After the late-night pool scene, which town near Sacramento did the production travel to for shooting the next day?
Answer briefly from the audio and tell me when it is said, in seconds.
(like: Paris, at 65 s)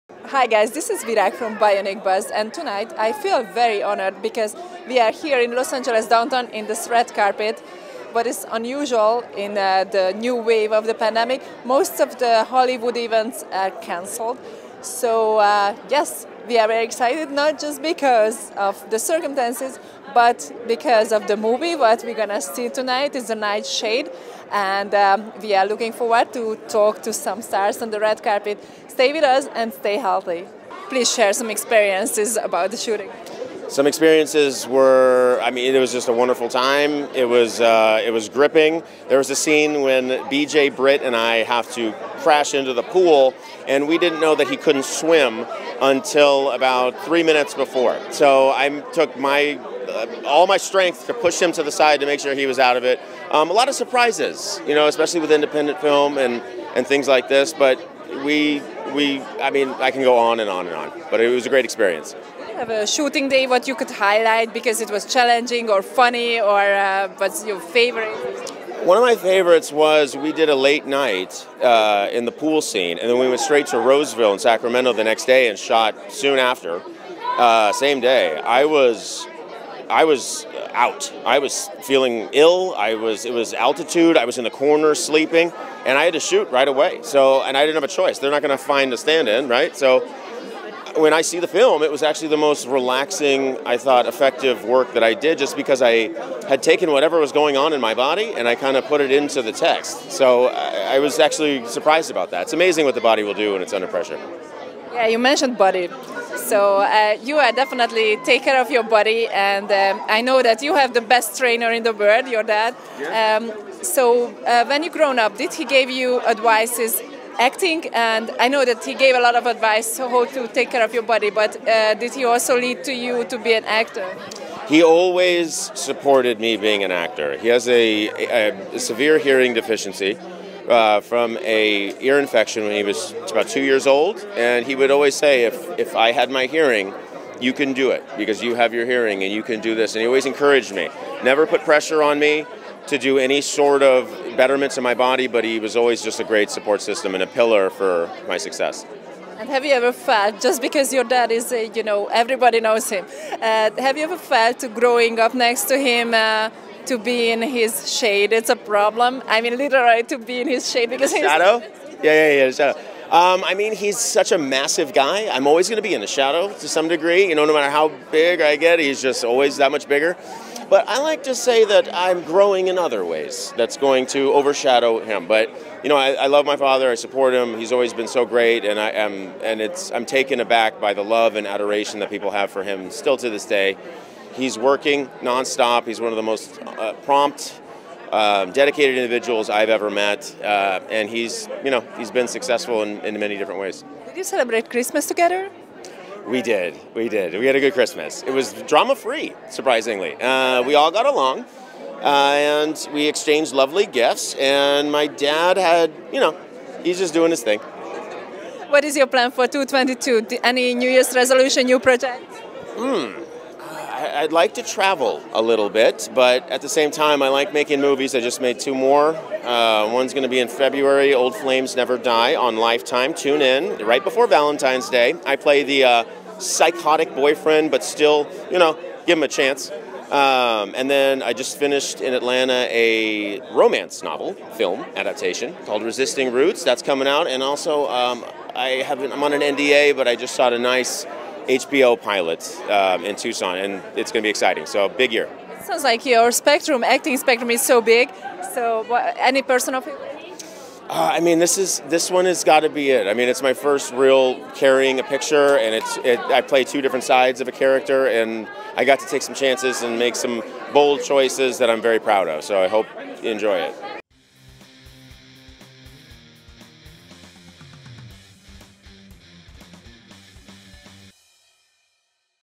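Roseville, at 73 s.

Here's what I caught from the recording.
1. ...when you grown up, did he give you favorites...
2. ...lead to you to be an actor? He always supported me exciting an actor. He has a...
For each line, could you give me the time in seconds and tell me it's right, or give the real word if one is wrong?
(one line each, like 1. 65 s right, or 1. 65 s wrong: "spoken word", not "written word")
1. 114 s wrong: "advices", not "favorites"
2. 122 s wrong: "being", not "exciting".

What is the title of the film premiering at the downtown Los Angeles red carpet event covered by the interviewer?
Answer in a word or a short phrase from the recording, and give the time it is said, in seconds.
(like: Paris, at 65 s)
The Nightshade, at 23 s.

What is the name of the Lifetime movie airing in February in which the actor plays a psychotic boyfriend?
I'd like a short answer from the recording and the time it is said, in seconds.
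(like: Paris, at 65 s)
Old Flames Never Die, at 221 s.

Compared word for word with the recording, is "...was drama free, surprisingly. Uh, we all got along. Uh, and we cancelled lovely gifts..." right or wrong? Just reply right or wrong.
wrong.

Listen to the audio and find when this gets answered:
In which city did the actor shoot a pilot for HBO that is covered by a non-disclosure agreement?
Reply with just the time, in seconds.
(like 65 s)
243 s.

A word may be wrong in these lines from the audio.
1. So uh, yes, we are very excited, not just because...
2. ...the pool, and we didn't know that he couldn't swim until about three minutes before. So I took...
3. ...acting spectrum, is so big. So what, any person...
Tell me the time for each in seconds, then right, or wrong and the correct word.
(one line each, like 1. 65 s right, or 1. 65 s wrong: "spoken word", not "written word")
1. 14 s right
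2. 42 s right
3. 246 s right.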